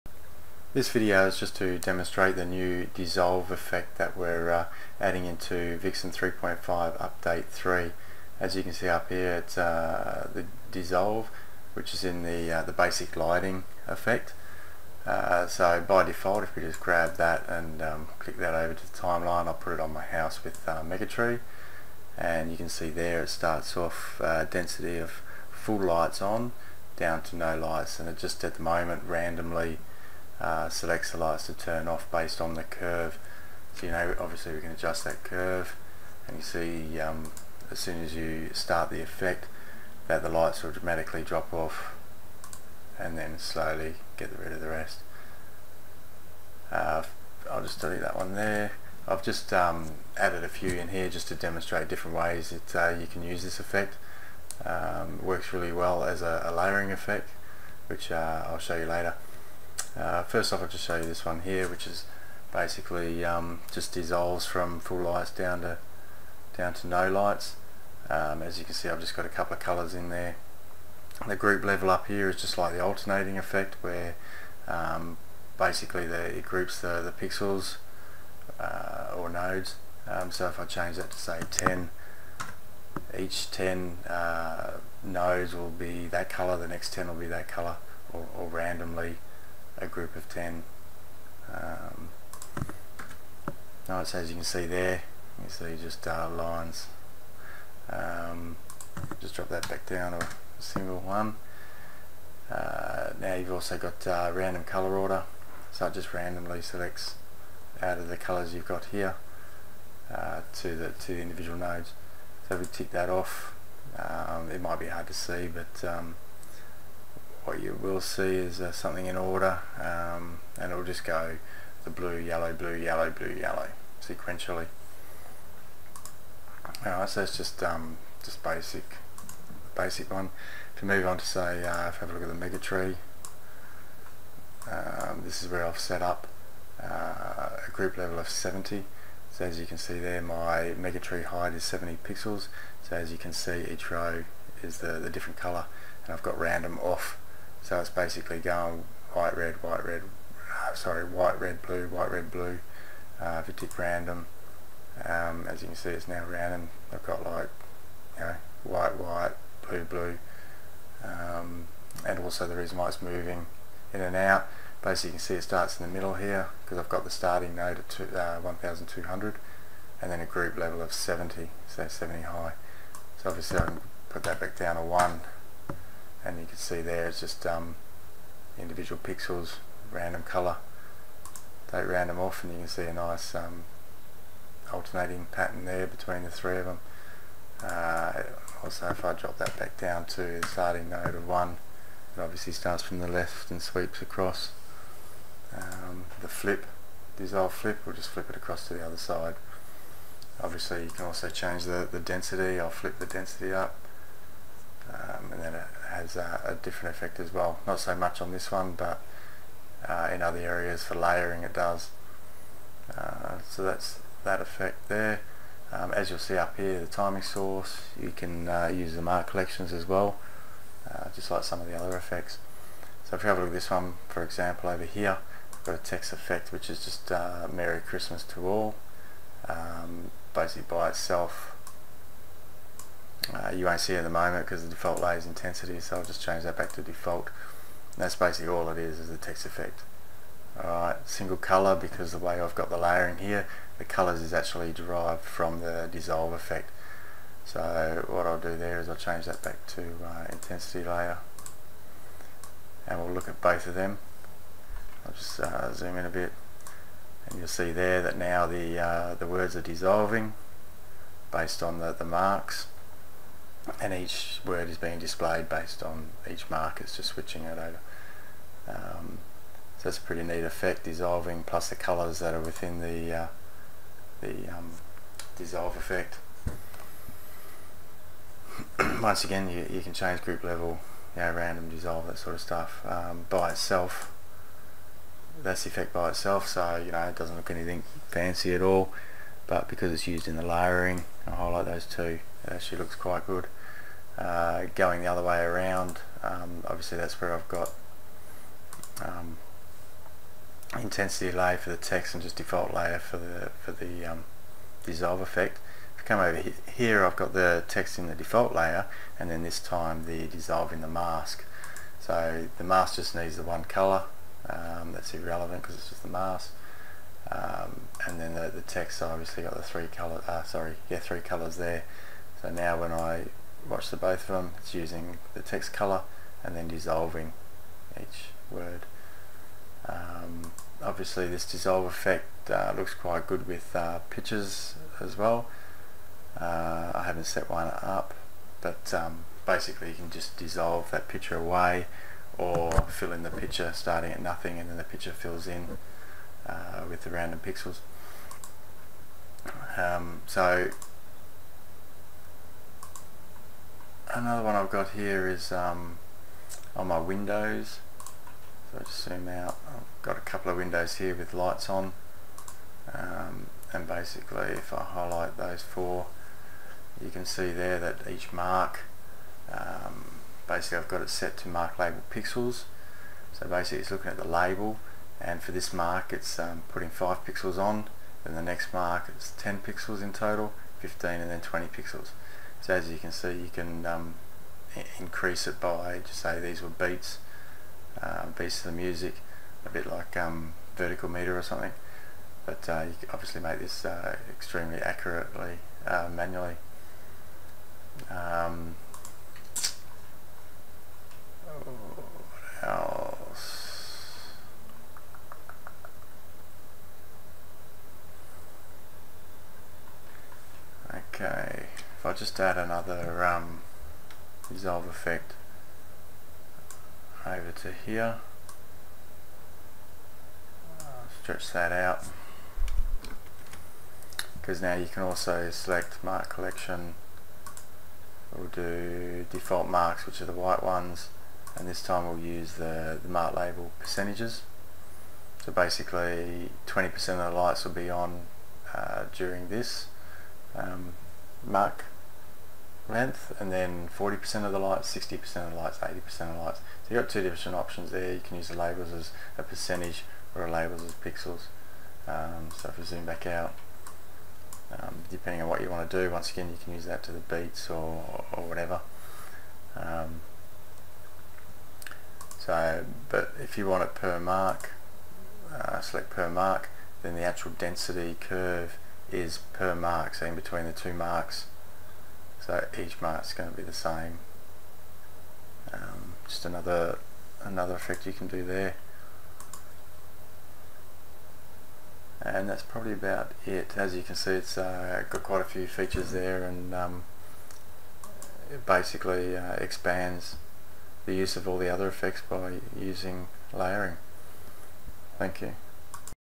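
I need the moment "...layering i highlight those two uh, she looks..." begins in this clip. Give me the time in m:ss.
4:50.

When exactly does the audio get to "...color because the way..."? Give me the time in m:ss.
4:01.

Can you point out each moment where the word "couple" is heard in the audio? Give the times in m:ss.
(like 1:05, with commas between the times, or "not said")
1:09, 6:00.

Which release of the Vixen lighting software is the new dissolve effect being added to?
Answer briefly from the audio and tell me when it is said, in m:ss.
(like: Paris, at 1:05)
3.5 update 3, at 0:06.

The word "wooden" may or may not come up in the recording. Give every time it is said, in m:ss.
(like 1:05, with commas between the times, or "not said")
not said.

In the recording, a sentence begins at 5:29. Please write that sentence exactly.
Um, obviously this dissolve effect uh, looks quite good with uh, pictures as well.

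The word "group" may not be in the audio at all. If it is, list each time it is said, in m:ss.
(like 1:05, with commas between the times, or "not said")
1:11, 1:16, 1:29, 2:17, 2:50, 4:40.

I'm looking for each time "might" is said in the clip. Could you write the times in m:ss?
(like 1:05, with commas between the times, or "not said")
1:54.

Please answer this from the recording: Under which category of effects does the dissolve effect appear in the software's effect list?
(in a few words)
basic lighting.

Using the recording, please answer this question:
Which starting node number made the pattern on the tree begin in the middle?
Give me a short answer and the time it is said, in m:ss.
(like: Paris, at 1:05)
1200, at 2:48.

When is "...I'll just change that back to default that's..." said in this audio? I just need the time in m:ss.
3:55.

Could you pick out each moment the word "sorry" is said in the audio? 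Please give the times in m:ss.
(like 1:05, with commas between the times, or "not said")
2:30, 5:20.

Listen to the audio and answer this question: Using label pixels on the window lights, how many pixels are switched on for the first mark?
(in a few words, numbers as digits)
5.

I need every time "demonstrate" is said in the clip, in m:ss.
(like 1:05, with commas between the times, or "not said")
0:01, 0:51.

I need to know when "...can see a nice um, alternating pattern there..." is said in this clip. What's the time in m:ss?
3:02.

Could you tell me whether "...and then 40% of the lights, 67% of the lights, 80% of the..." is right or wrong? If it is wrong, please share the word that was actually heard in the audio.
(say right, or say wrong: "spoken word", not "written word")
wrong: "60", not "67".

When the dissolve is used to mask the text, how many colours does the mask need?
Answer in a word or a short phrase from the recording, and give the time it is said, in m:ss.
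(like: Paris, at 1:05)
1, at 5:13.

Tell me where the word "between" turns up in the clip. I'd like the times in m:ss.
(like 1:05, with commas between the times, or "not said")
3:05, 7:50.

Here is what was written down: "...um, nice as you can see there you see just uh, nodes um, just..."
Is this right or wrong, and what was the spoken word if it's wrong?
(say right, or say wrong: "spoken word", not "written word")
wrong: "lines", not "nodes".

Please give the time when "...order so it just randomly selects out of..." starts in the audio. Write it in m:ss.
1:44.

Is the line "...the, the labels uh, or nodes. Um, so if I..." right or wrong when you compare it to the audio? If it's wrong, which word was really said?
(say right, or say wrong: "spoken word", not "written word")
wrong: "pixels", not "labels".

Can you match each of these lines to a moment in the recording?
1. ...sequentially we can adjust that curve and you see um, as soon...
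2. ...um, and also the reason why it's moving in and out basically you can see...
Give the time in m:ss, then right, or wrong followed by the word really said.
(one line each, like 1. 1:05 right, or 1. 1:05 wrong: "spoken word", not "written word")
1. 0:34 wrong: "obviously", not "sequentially"
2. 2:41 right.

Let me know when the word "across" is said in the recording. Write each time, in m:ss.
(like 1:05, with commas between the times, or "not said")
3:14, 3:18.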